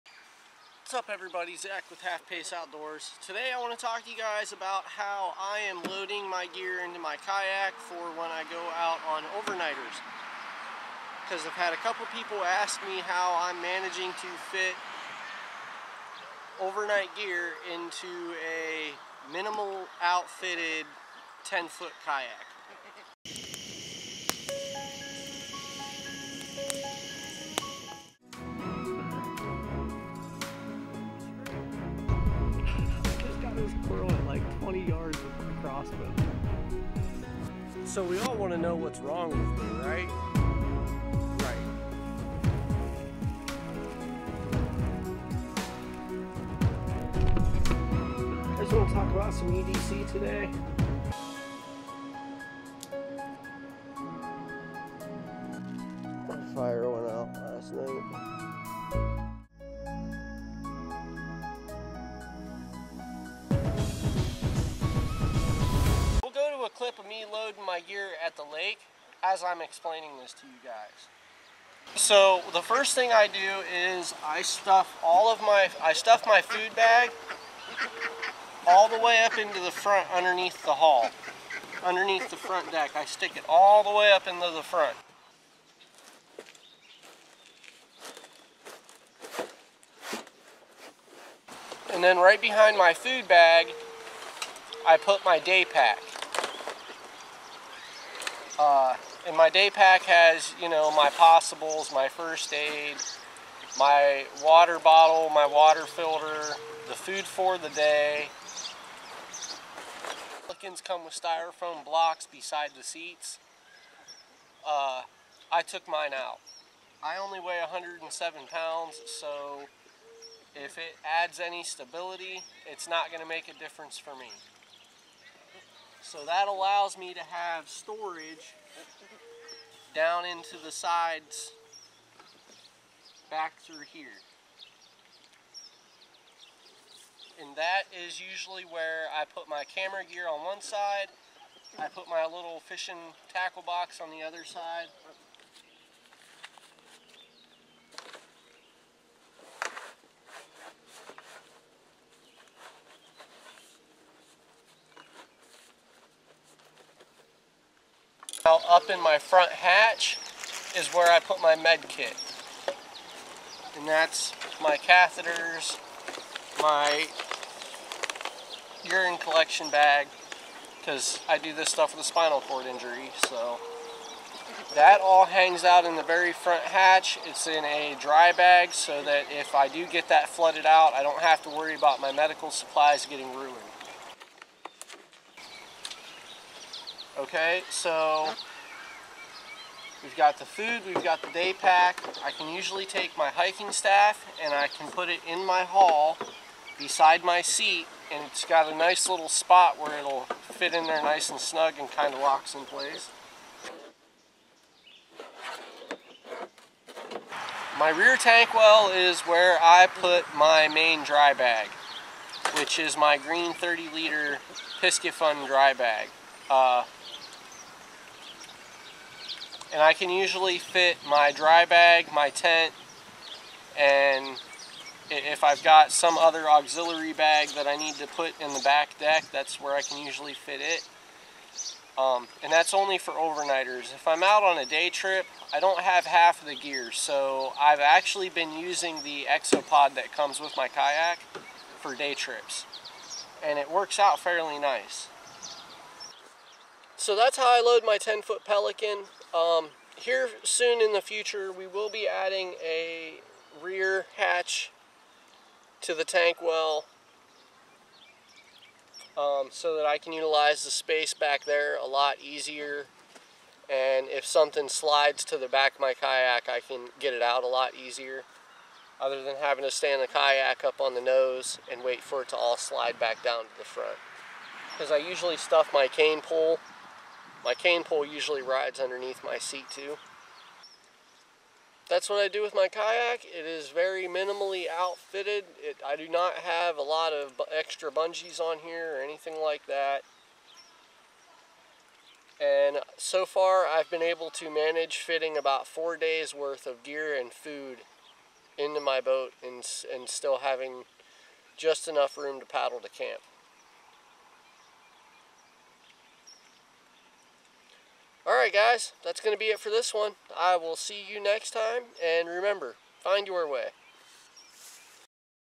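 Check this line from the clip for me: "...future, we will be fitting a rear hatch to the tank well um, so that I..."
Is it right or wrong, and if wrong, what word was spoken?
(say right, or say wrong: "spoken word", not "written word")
wrong: "adding", not "fitting".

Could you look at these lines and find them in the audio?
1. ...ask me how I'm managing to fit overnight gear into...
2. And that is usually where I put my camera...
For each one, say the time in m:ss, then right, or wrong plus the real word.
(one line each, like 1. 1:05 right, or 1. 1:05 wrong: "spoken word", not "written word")
1. 0:12 right
2. 2:17 right.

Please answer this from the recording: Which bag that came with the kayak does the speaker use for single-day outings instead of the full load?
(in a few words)
ExoPak.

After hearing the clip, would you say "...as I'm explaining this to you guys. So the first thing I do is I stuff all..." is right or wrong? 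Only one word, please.
right.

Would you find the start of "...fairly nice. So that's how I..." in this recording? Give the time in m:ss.
4:04.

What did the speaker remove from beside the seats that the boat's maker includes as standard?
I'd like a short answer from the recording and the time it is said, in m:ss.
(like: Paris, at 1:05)
styrofoam blocks, at 1:51.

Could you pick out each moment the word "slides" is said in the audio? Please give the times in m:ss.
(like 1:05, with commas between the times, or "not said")
4:24, 4:32.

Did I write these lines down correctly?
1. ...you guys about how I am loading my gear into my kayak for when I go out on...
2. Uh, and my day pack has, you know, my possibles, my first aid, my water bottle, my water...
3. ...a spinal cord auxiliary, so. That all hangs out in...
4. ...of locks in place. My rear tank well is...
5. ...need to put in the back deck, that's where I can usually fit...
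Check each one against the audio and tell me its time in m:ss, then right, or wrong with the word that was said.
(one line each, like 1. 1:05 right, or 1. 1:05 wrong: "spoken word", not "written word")
1. 0:04 right
2. 1:38 right
3. 2:52 wrong: "injury", not "auxiliary"
4. 3:22 right
5. 3:47 right.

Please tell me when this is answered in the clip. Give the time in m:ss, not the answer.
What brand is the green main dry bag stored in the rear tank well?
3:34.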